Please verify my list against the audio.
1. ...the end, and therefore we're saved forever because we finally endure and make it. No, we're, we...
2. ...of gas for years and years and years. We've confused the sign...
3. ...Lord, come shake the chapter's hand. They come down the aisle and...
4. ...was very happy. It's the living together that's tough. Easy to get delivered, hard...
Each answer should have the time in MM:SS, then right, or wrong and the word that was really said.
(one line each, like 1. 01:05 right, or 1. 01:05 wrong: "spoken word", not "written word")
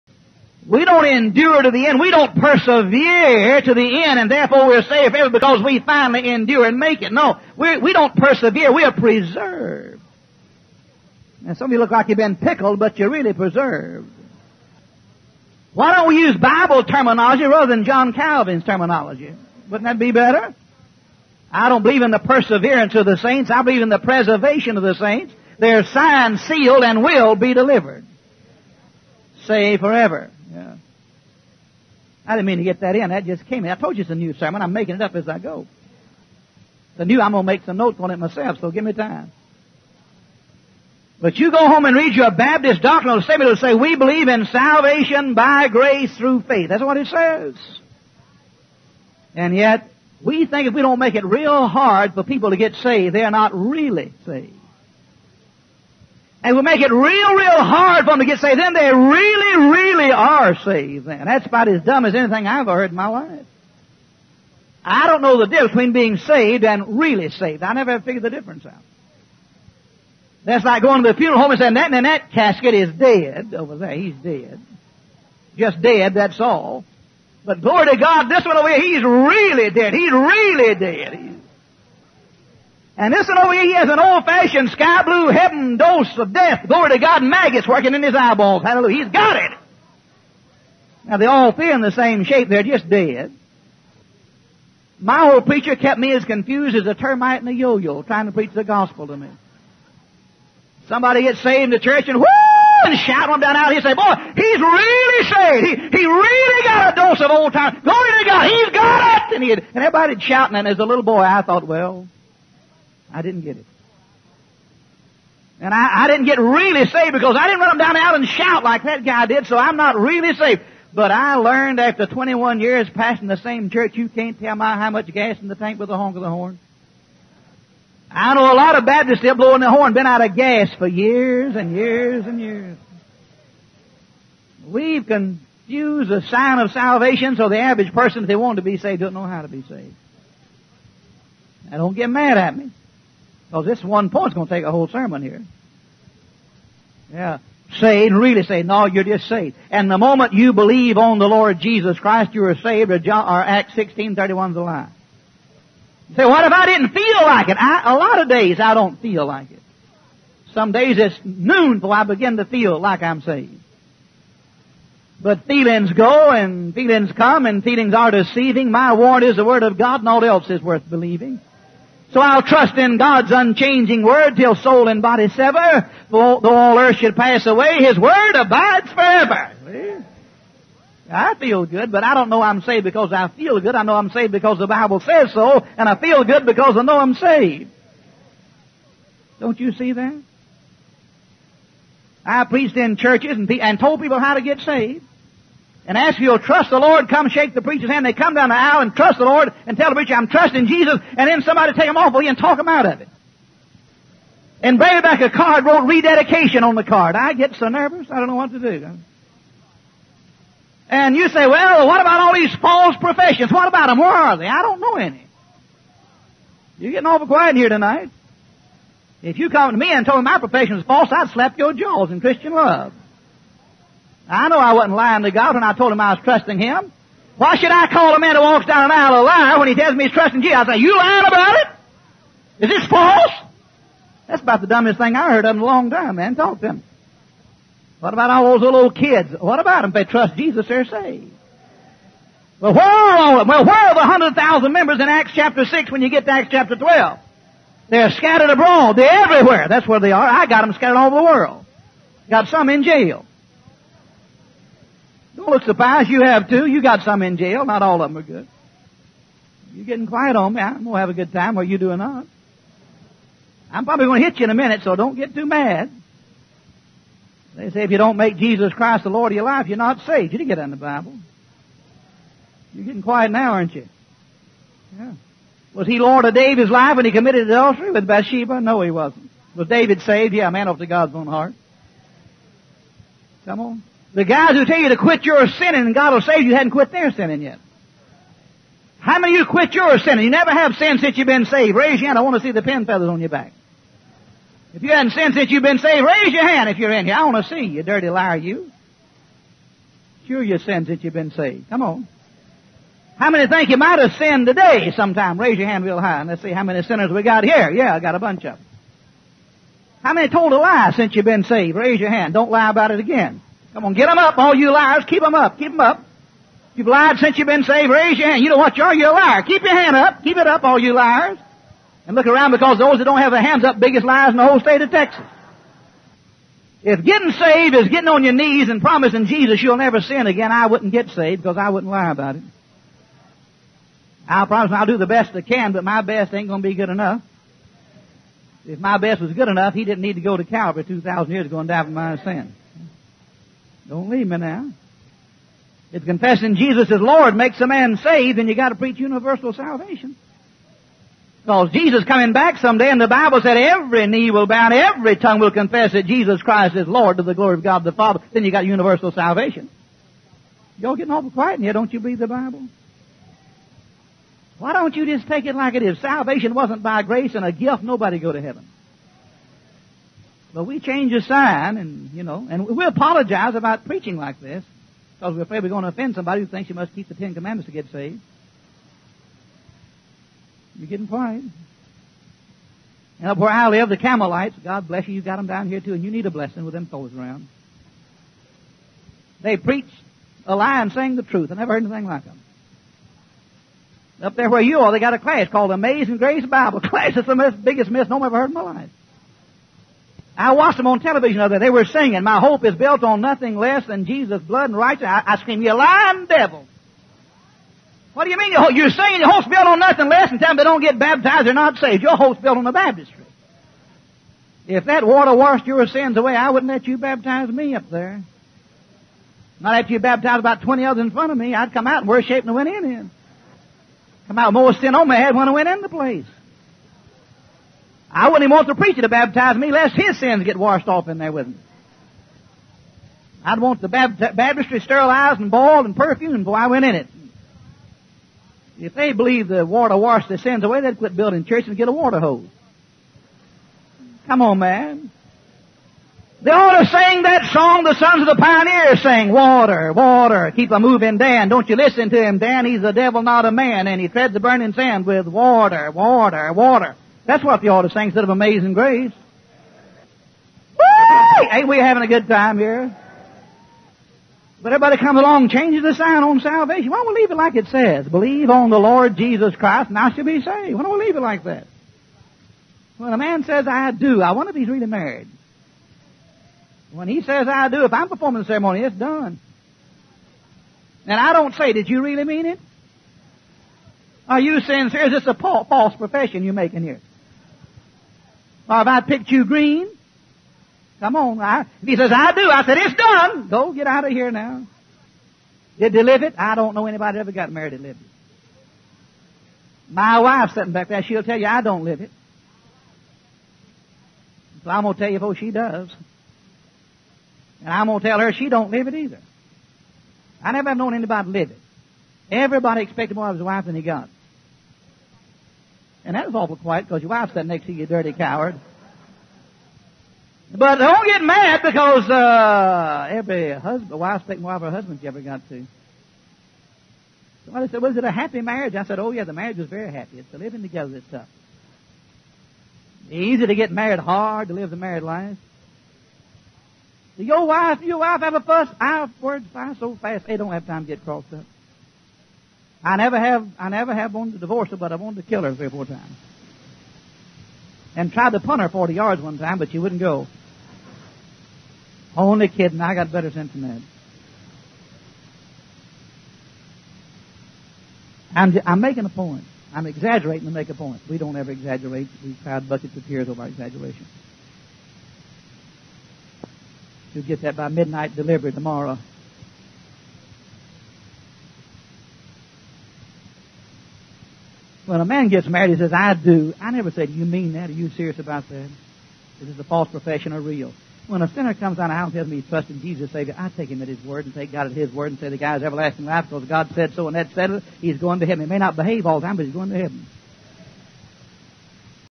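1. 00:03 right
2. 02:10 right
3. 03:16 wrong: "preacher", not "chapter"
4. 08:49 wrong: "married", not "delivered".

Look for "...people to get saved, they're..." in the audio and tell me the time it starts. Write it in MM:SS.
00:52.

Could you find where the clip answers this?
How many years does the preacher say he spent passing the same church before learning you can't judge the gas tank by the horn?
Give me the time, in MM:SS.
02:02.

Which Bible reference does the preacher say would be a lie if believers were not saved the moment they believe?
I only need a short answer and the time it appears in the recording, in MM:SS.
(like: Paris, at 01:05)
Acts 16:31, at 02:33.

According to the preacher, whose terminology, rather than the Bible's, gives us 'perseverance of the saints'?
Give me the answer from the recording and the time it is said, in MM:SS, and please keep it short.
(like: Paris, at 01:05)
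John Calvin, at 00:17.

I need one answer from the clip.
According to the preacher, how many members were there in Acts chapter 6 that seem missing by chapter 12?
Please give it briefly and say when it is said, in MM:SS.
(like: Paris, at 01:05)
100,000, at 04:03.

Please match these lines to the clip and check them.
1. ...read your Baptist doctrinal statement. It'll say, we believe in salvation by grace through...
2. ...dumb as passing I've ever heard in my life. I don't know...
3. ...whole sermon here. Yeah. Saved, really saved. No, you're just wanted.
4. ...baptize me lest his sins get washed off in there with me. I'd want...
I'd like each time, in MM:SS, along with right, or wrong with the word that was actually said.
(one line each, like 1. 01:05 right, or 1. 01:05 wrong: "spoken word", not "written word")
1. 00:41 right
2. 01:01 wrong: "anything", not "passing"
3. 02:24 wrong: "saved", not "wanted"
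4. 07:09 right.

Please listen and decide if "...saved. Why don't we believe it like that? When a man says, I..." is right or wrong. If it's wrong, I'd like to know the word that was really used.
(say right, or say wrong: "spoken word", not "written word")
wrong: "leave", not "believe".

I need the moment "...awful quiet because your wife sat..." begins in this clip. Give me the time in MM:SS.
08:36.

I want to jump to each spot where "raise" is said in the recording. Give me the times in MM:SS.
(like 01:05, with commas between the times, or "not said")
04:51, 04:56, 05:05, 05:11, 05:17.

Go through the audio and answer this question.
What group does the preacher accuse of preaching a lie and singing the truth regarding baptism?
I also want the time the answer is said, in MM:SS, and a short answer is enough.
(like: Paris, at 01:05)
Campbellites, at 06:23.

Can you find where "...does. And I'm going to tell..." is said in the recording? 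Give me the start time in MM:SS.
08:25.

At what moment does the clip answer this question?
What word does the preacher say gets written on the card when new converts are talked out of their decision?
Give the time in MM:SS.
03:25.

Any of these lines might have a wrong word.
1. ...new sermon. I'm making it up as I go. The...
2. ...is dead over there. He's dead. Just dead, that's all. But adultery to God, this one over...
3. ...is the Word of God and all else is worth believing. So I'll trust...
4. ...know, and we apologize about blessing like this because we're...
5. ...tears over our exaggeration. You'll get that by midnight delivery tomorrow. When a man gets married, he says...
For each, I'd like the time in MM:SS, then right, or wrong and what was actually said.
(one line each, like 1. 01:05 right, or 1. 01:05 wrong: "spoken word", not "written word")
1. 00:34 right
2. 01:12 wrong: "glory", not "adultery"
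3. 02:49 right
4. 06:12 wrong: "preaching", not "blessing"
5. 09:23 right.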